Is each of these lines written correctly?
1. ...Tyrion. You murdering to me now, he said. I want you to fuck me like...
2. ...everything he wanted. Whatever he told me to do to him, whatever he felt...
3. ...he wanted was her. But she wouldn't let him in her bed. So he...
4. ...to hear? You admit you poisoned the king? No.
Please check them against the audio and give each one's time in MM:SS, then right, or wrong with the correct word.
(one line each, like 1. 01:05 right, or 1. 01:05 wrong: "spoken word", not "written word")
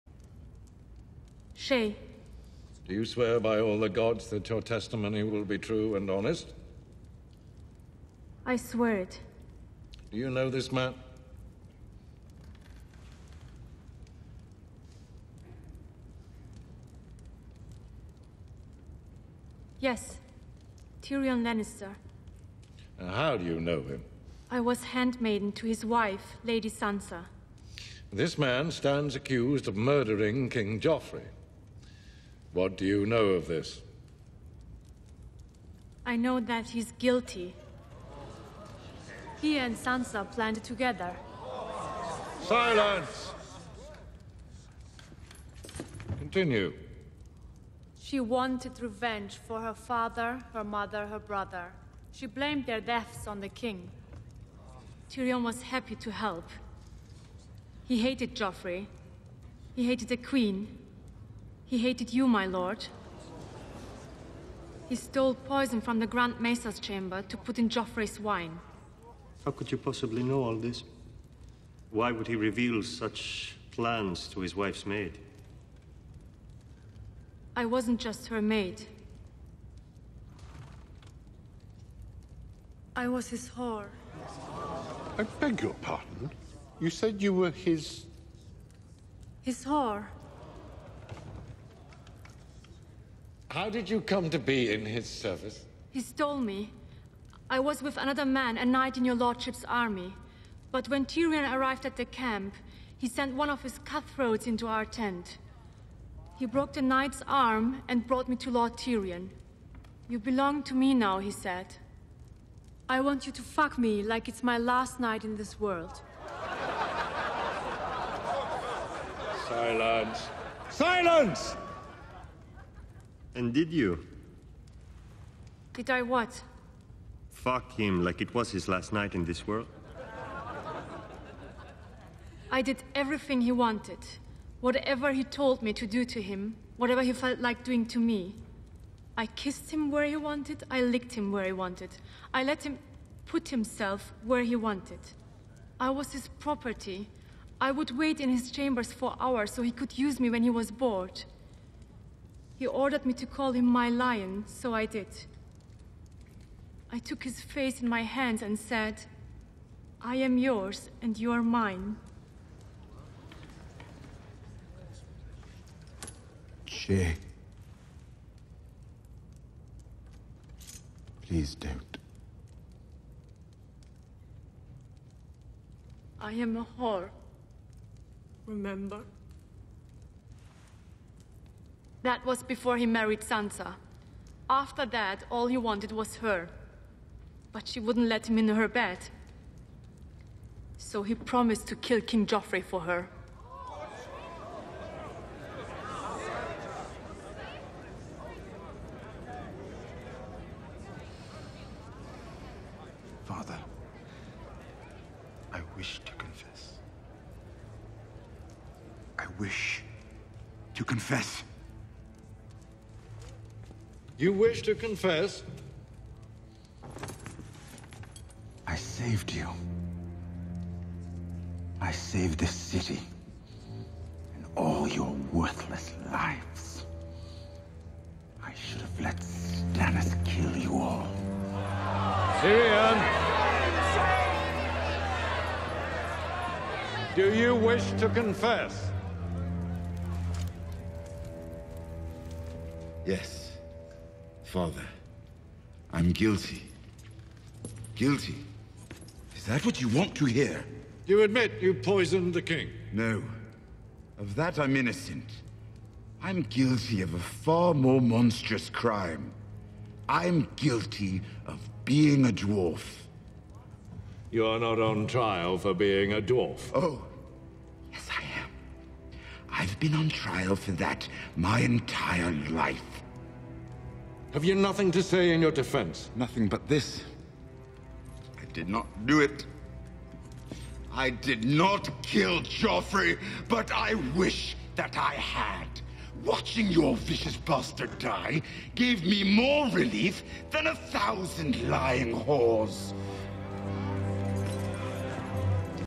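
1. 01:48 wrong: "belong", not "murdering"
2. 02:12 right
3. 03:05 right
4. 04:10 right.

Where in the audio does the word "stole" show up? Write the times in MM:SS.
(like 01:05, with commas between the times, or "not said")
01:04, 01:35.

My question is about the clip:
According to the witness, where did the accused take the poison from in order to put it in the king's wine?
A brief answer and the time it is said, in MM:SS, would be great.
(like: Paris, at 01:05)
The Grand Maester's chamber, at 01:05.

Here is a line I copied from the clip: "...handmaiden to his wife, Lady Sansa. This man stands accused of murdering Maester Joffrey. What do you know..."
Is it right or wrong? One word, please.
wrong.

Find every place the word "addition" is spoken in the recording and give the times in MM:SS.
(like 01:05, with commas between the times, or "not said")
not said.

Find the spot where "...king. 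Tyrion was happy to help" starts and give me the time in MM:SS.
00:53.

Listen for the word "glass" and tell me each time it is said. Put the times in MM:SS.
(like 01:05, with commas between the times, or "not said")
not said.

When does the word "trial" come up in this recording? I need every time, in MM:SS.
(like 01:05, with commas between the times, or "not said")
04:25, 04:30.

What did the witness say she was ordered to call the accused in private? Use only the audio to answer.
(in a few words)
My lion.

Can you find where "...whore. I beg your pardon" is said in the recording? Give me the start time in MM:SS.
01:23.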